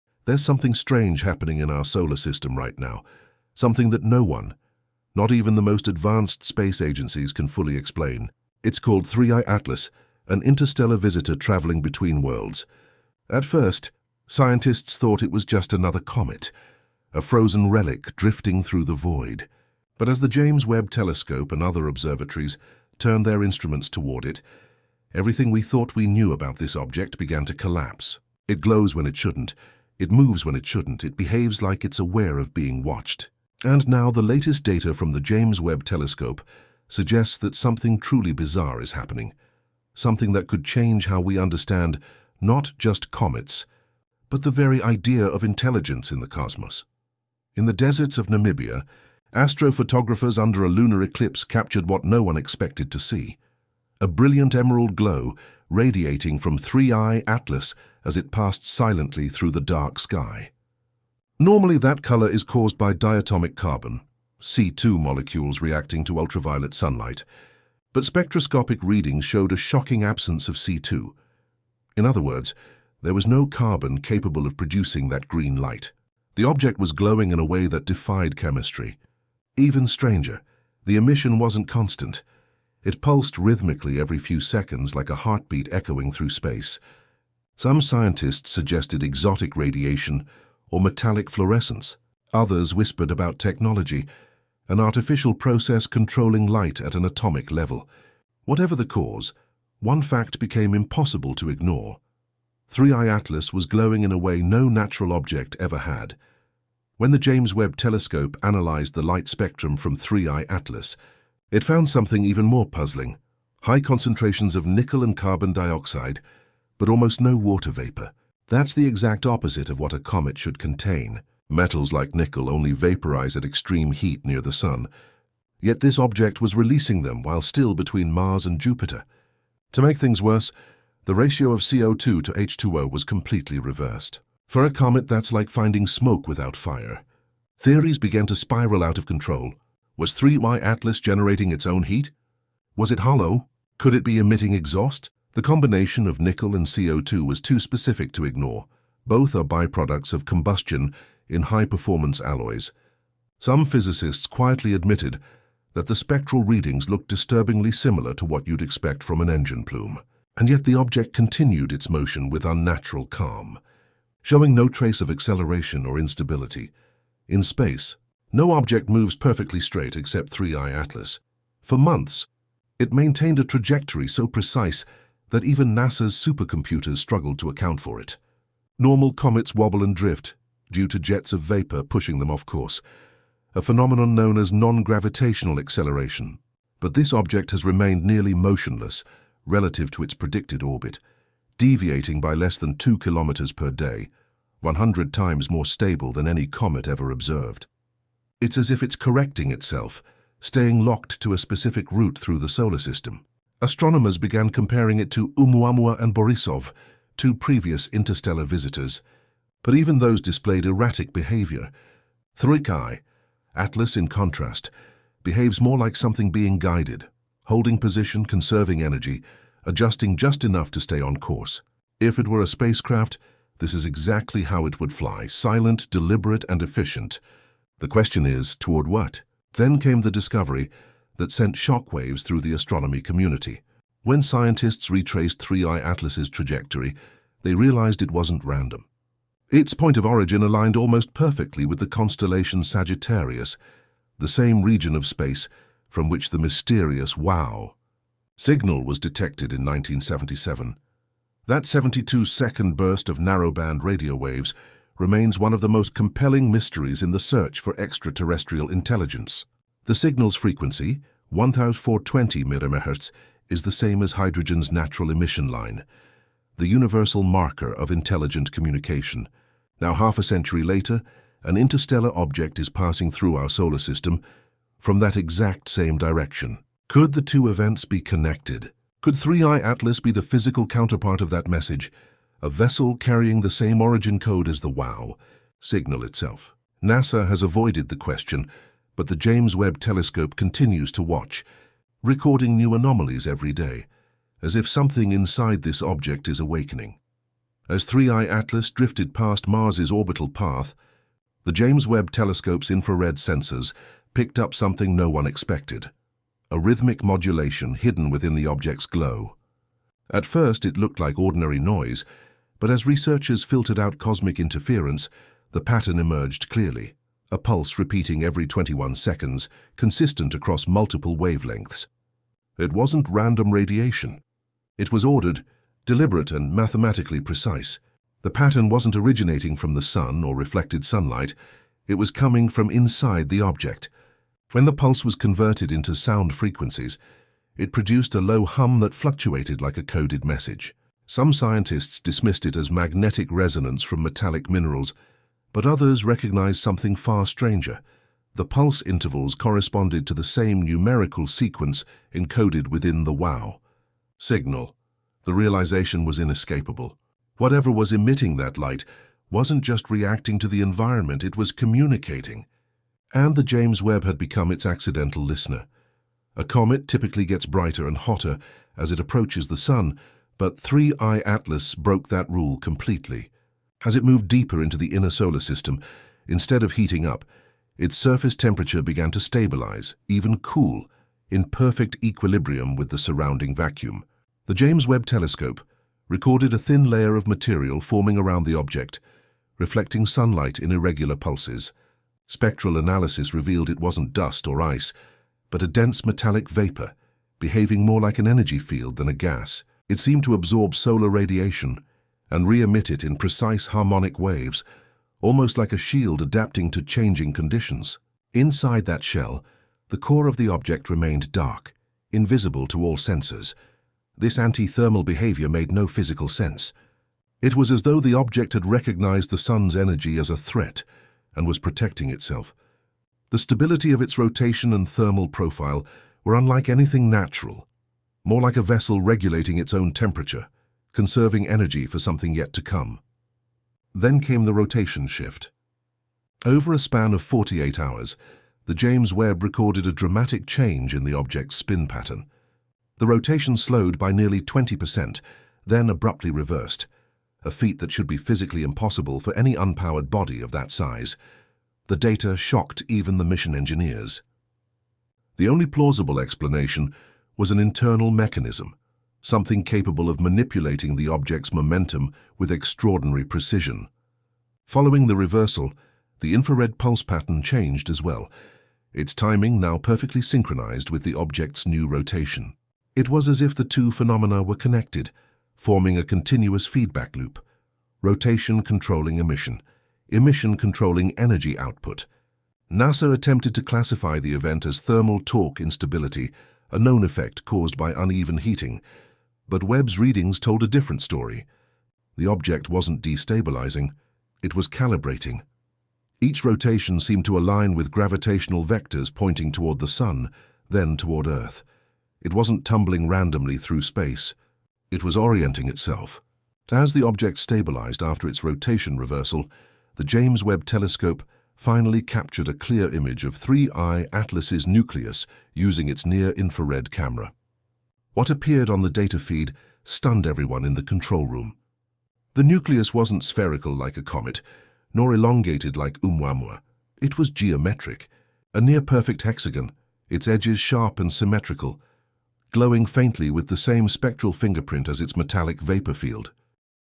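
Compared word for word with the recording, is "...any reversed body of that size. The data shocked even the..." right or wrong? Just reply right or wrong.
wrong.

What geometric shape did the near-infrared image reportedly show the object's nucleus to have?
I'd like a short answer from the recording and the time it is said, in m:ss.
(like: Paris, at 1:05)
hexagon, at 8:49.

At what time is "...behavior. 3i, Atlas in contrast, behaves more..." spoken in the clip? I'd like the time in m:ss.
3:31.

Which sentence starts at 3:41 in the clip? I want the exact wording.
If it were a spacecraft, this is exactly how it would fly, silent, deliberate, and efficient, the question is, toward what?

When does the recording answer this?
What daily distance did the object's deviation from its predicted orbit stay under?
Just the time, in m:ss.
3:12.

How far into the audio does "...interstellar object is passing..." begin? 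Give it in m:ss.
4:31.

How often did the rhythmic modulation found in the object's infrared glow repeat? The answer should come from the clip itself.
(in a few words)
every 21 seconds.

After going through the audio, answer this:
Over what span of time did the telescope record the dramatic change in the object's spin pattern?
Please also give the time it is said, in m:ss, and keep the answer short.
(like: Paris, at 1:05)
48 hours, at 7:17.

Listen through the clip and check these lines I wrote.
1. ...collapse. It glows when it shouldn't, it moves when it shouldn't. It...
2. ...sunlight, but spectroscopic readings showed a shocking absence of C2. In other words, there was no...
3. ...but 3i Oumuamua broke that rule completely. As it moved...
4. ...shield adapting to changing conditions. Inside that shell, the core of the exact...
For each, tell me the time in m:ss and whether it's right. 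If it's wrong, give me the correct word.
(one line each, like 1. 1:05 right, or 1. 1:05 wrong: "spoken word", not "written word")
1. 0:27 right
2. 1:06 right
3. 6:10 wrong: "Atlas", not "Oumuamua"
4. 6:45 wrong: "object", not "exact".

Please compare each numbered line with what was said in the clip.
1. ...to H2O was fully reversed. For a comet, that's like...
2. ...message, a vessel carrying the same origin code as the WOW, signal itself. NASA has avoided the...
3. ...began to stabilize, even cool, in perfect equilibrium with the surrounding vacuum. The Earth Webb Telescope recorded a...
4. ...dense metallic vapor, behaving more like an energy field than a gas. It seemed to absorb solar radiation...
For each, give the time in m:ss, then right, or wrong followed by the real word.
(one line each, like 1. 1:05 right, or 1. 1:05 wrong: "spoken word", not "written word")
1. 2:12 wrong: "completely", not "fully"
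2. 4:41 right
3. 6:18 wrong: "James", not "Earth"
4. 6:35 right.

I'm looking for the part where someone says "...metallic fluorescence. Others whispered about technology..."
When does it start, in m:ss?
1:30.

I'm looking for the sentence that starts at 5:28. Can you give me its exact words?
The pattern wasn't originating from the sun or reflected sunlight.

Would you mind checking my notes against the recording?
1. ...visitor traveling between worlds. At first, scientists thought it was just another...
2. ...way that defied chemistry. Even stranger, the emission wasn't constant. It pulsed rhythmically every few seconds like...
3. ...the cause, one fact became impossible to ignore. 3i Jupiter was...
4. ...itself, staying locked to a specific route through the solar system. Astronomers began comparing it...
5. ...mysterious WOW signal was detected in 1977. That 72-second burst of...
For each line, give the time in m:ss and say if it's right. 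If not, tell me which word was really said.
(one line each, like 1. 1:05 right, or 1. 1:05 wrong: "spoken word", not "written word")
1. 0:10 right
2. 1:17 right
3. 1:38 wrong: "Atlas", not "Jupiter"
4. 3:19 right
5. 4:06 right.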